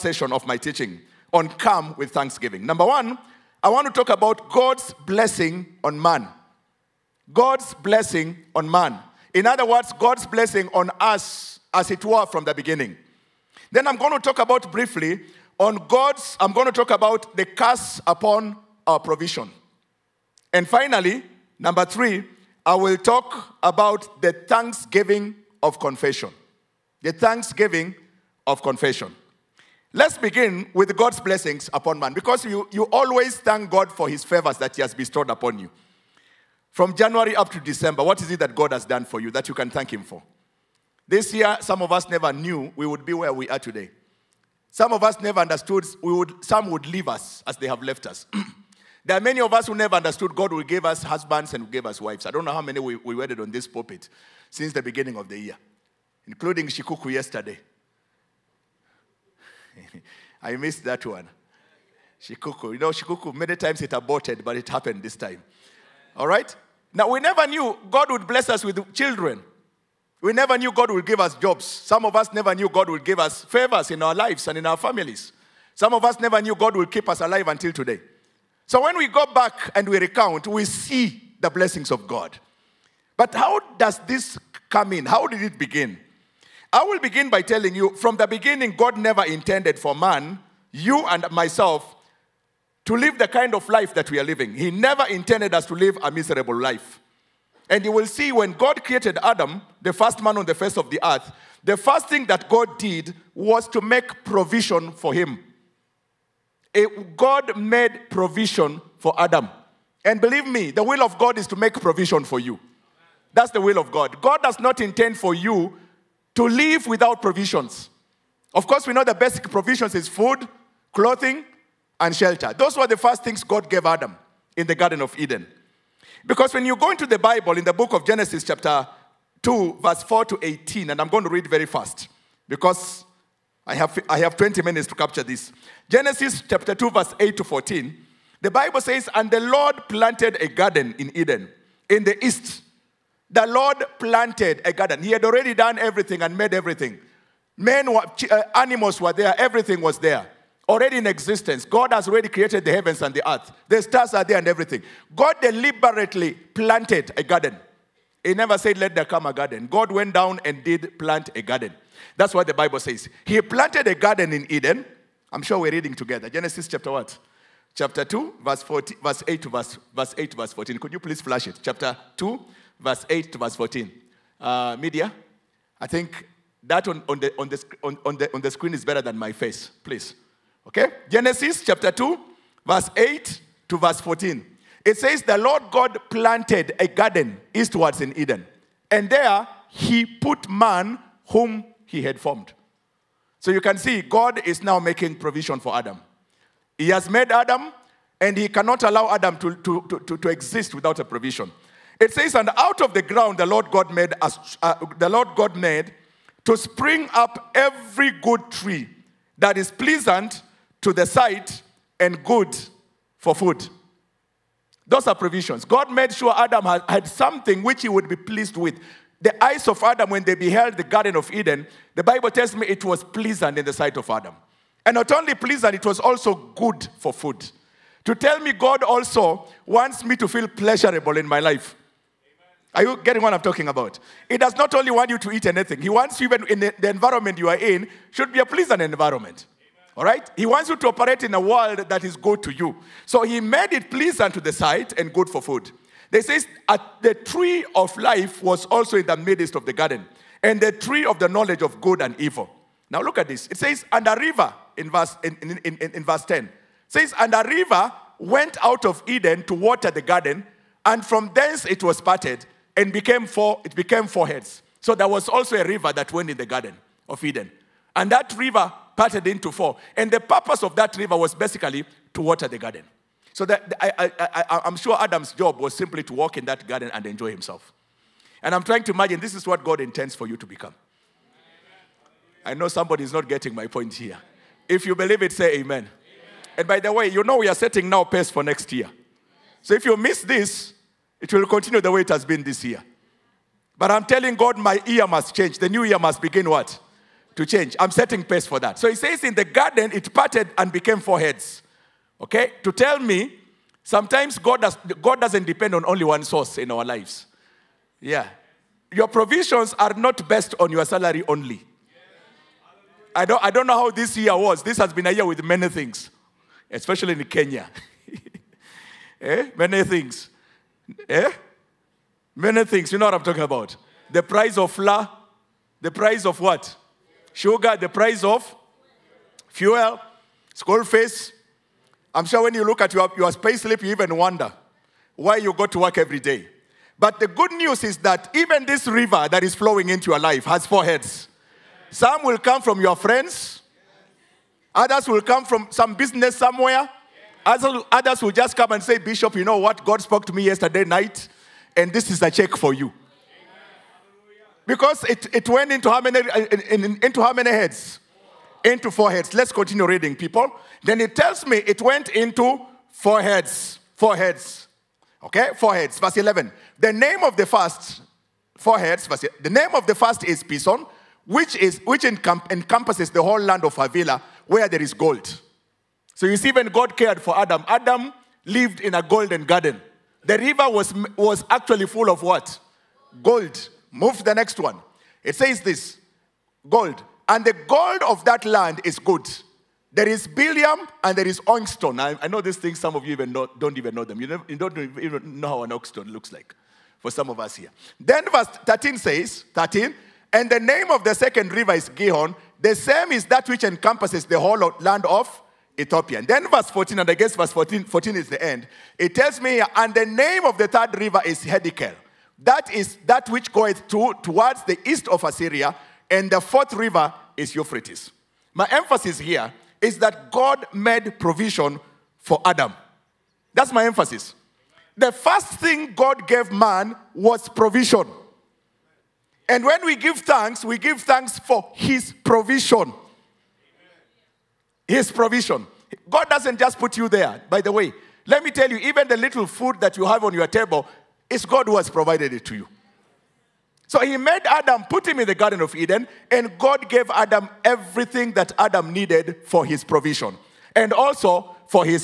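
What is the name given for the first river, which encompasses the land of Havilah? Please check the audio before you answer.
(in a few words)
Pison.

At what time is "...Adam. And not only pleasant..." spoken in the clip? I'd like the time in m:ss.
3:44.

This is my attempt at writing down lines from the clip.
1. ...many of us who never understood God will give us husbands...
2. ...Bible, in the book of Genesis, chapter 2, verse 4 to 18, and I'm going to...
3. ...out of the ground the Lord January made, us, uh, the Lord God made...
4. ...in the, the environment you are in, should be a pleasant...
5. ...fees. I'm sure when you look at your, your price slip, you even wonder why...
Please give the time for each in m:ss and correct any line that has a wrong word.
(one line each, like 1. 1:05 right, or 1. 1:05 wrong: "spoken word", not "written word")
1. 0:49 right
2. 2:07 right
3. 3:22 wrong: "God", not "January"
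4. 3:56 right
5. 5:30 wrong: "space", not "price".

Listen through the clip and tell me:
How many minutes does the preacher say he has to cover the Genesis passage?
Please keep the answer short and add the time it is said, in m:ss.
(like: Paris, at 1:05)
20, at 2:14.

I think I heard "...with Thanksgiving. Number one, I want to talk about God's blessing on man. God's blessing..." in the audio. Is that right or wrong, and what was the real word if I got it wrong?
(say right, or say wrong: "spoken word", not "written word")
right.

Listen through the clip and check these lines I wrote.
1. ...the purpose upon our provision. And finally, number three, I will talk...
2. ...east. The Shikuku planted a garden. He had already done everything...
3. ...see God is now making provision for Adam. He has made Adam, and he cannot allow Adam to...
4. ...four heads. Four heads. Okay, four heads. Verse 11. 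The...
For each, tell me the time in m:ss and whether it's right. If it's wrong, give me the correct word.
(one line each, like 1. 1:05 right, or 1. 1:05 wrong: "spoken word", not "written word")
1. 0:17 wrong: "curse", not "purpose"
2. 2:22 wrong: "Lord", not "Shikuku"
3. 3:13 right
4. 6:02 right.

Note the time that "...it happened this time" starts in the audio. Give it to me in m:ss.
1:04.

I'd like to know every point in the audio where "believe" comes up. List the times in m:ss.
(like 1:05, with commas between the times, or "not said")
1:50, 4:44.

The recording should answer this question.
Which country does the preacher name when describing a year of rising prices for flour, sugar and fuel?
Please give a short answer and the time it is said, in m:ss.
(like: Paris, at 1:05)
Kenya, at 5:17.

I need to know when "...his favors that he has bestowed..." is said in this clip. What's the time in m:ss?
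0:34.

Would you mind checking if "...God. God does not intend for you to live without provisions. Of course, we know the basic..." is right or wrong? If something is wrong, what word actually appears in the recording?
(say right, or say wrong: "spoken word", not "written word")
right.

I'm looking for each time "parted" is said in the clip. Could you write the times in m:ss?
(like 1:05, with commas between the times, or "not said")
4:21, 4:28, 5:00.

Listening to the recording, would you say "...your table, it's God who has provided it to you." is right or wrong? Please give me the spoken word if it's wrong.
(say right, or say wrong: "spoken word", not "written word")
right.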